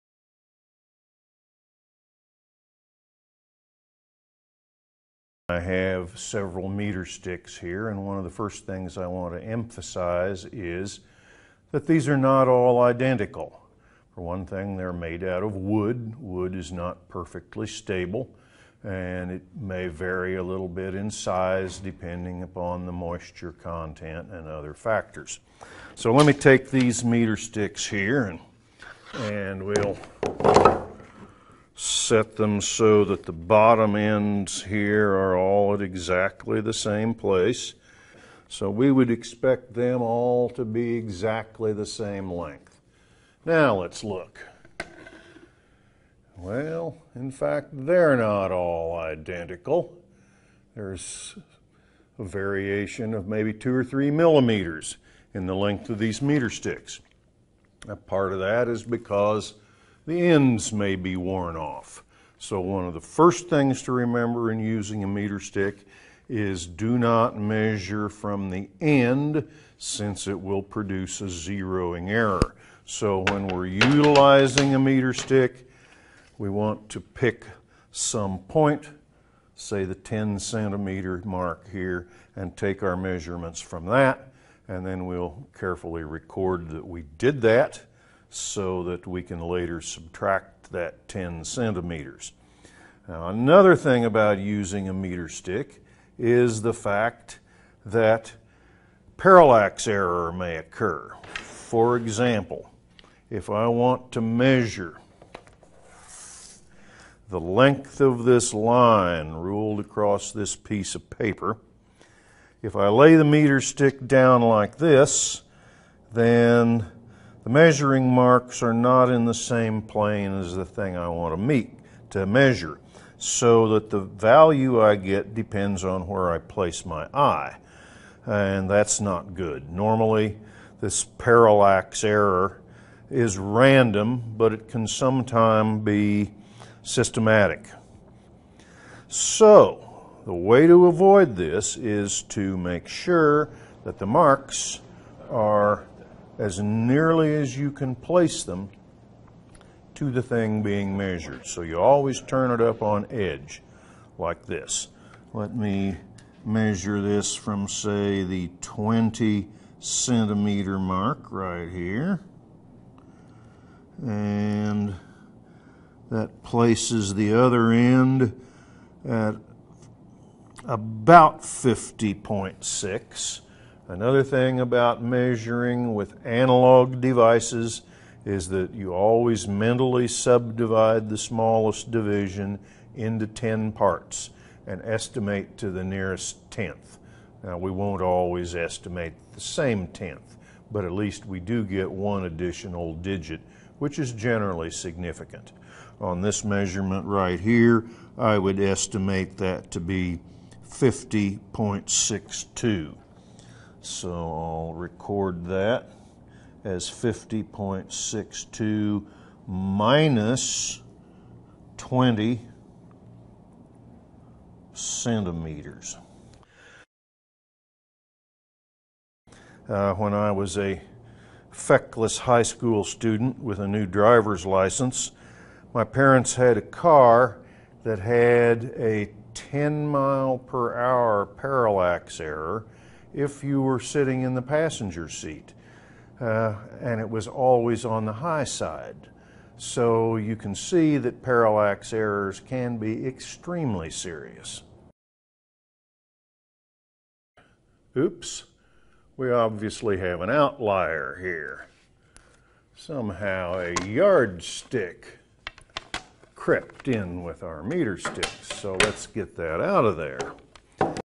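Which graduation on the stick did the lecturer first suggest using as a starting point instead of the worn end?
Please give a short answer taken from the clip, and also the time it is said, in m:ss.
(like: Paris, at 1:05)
10 centimeter mark, at 1:19.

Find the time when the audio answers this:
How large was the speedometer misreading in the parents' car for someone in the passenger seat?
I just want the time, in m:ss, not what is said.
3:49.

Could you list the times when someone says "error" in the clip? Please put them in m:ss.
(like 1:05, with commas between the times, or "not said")
1:12, 1:39, 2:12, 3:52, 4:01.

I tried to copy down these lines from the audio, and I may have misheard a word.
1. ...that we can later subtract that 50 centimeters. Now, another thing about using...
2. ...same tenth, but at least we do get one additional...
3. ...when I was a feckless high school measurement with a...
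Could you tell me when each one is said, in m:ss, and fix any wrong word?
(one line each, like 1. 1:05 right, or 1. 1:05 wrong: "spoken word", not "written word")
1. 1:28 wrong: "10", not "50"
2. 3:09 right
3. 3:39 wrong: "student", not "measurement".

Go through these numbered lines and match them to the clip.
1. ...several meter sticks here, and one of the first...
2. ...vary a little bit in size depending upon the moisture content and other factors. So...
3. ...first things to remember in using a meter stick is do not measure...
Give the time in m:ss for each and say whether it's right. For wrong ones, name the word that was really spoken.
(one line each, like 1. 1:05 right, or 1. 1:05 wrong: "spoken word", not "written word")
1. 0:06 right
2. 0:19 right
3. 1:03 right.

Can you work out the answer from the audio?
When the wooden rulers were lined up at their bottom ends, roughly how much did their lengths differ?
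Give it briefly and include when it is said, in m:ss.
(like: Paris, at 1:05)
2 or 3 millimeters, at 0:53.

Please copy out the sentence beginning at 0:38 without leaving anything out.
So we would expect them all to be exactly the same length.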